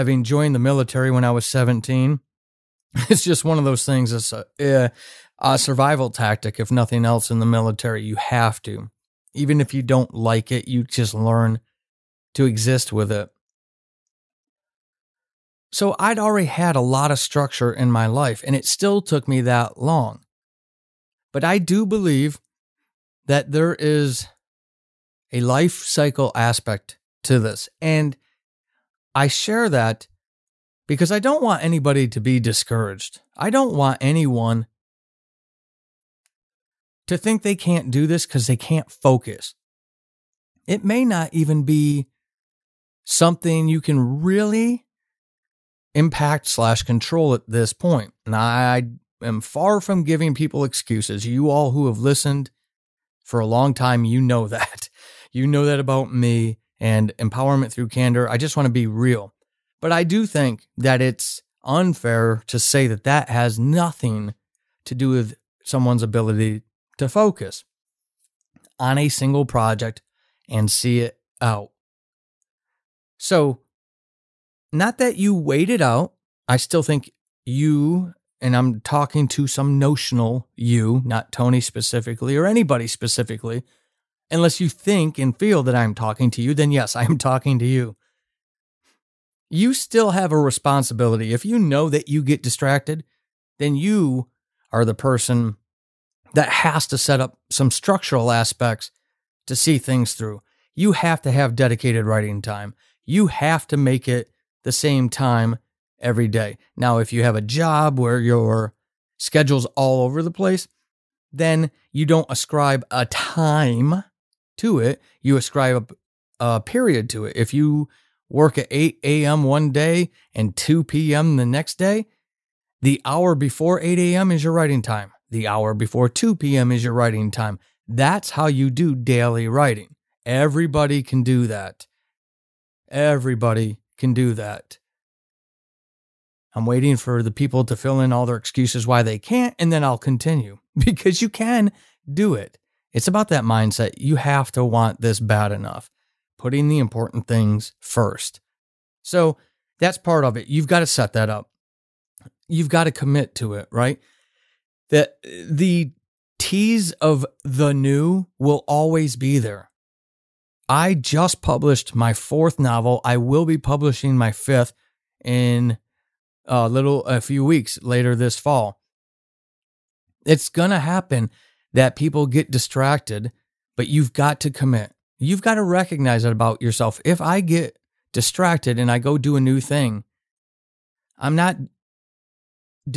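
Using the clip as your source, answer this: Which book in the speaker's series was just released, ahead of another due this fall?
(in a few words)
fourth.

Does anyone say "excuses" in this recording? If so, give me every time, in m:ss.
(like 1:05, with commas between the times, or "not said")
0:50, 2:18.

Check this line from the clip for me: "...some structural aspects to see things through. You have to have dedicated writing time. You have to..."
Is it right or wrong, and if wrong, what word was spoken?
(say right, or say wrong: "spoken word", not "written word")
right.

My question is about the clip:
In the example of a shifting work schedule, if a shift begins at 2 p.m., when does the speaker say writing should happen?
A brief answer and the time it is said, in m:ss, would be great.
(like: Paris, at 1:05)
the hour before 2 p.m., at 2:05.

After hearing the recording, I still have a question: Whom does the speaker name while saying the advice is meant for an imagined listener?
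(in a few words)
Tony.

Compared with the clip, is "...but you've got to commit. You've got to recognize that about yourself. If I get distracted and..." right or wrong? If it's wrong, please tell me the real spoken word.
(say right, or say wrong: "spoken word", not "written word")
right.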